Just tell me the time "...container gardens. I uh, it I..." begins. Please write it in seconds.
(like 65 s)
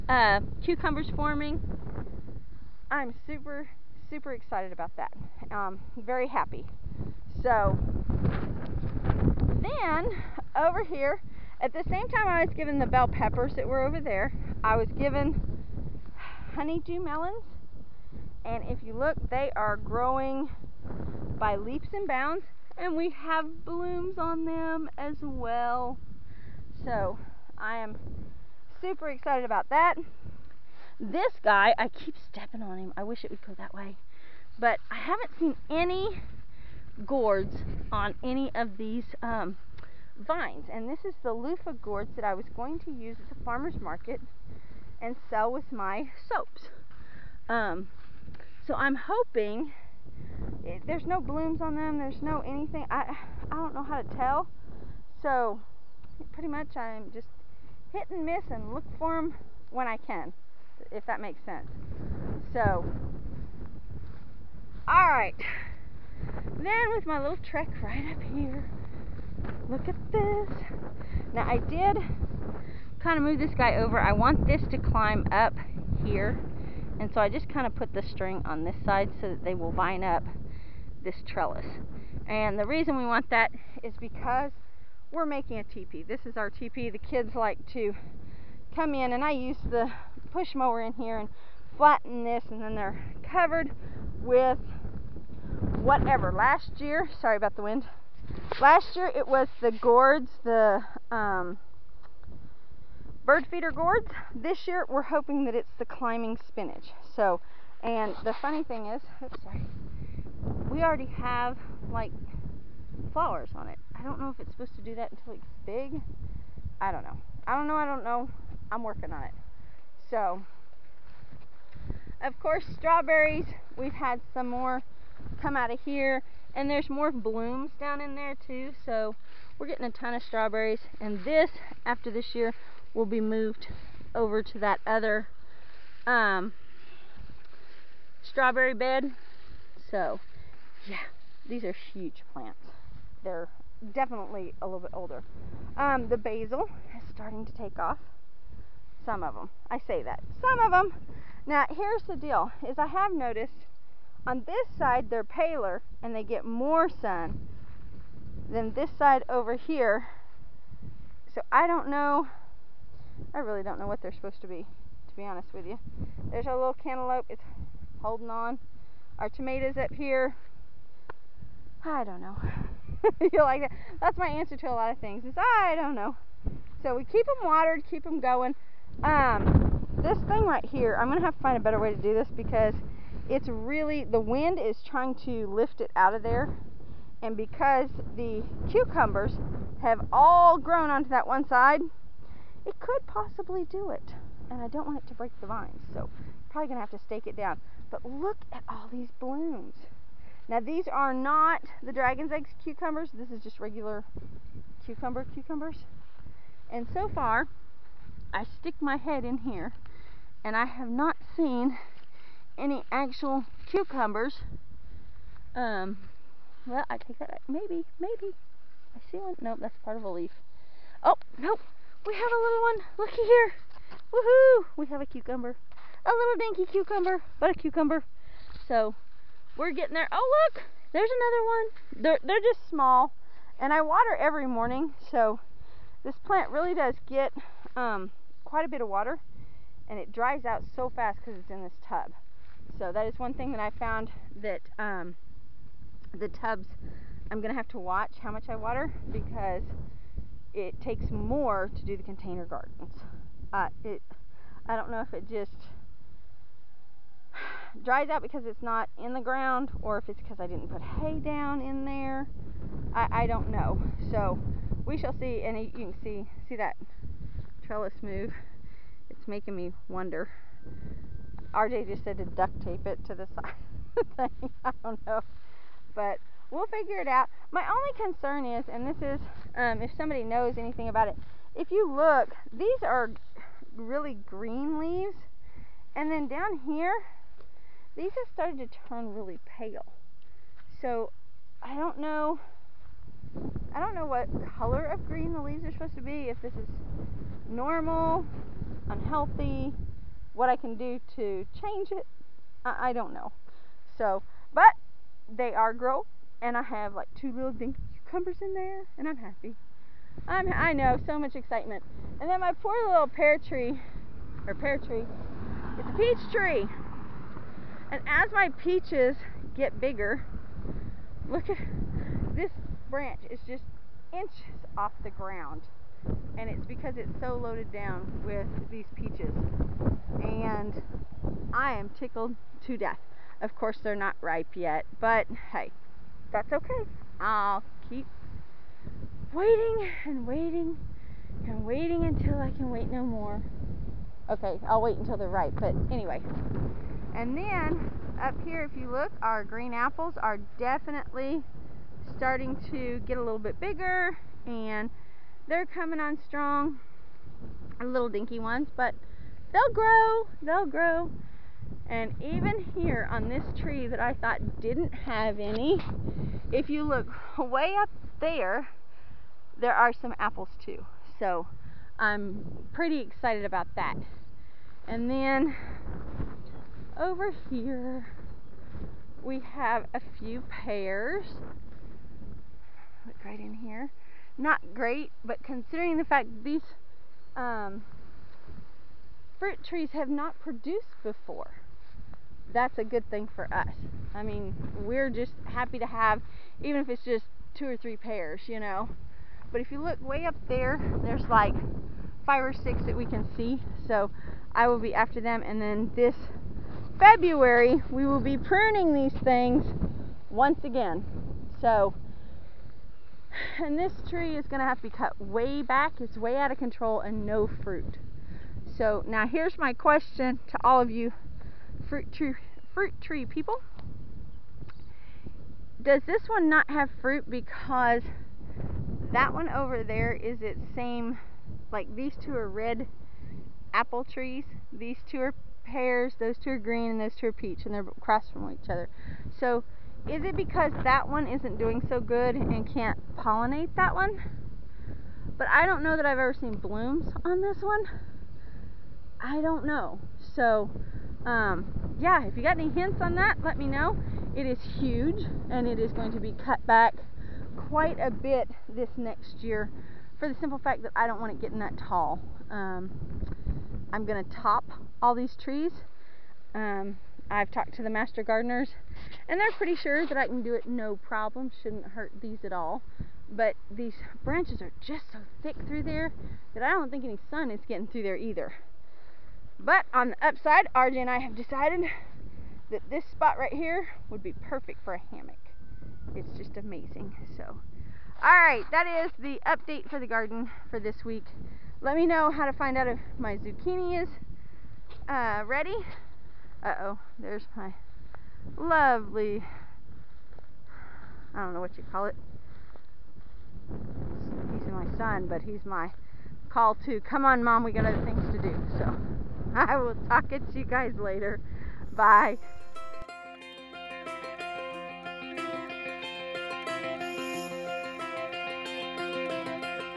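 252 s.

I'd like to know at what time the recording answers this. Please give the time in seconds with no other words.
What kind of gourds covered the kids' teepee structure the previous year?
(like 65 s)
103 s.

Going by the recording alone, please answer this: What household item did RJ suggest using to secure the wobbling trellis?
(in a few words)
Duct tape.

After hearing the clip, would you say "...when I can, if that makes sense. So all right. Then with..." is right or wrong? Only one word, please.
right.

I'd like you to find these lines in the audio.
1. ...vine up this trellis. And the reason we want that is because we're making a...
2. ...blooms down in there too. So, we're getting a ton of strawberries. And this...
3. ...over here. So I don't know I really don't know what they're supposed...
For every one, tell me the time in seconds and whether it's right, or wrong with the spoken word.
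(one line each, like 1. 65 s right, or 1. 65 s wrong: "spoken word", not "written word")
1. 79 s right
2. 127 s right
3. 159 s right.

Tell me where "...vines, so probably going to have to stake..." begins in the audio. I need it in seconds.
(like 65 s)
195 s.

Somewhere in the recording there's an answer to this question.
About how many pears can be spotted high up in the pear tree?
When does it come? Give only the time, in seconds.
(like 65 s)
402 s.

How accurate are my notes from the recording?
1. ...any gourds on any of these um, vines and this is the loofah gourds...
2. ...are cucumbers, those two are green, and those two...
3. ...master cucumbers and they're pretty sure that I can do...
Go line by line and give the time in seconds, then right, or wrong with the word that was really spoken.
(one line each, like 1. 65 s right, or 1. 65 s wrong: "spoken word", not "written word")
1. 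35 s right
2. 435 s wrong: "pears", not "cucumbers"
3. 467 s wrong: "gardeners", not "cucumbers".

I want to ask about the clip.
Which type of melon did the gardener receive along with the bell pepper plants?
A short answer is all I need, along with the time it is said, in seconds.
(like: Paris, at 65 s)
Honeydew melons, at 16 s.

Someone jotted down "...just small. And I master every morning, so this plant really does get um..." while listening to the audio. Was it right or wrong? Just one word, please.
wrong.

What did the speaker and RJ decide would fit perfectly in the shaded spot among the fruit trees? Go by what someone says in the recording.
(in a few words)
A hammock.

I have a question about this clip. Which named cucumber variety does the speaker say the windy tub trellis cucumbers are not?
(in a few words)
Dragon's eggs.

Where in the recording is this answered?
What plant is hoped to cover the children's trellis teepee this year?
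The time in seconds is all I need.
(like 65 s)
105 s.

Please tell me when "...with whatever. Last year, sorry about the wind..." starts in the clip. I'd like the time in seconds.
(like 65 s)
94 s.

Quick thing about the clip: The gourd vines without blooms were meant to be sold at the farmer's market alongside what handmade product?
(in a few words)
Soaps.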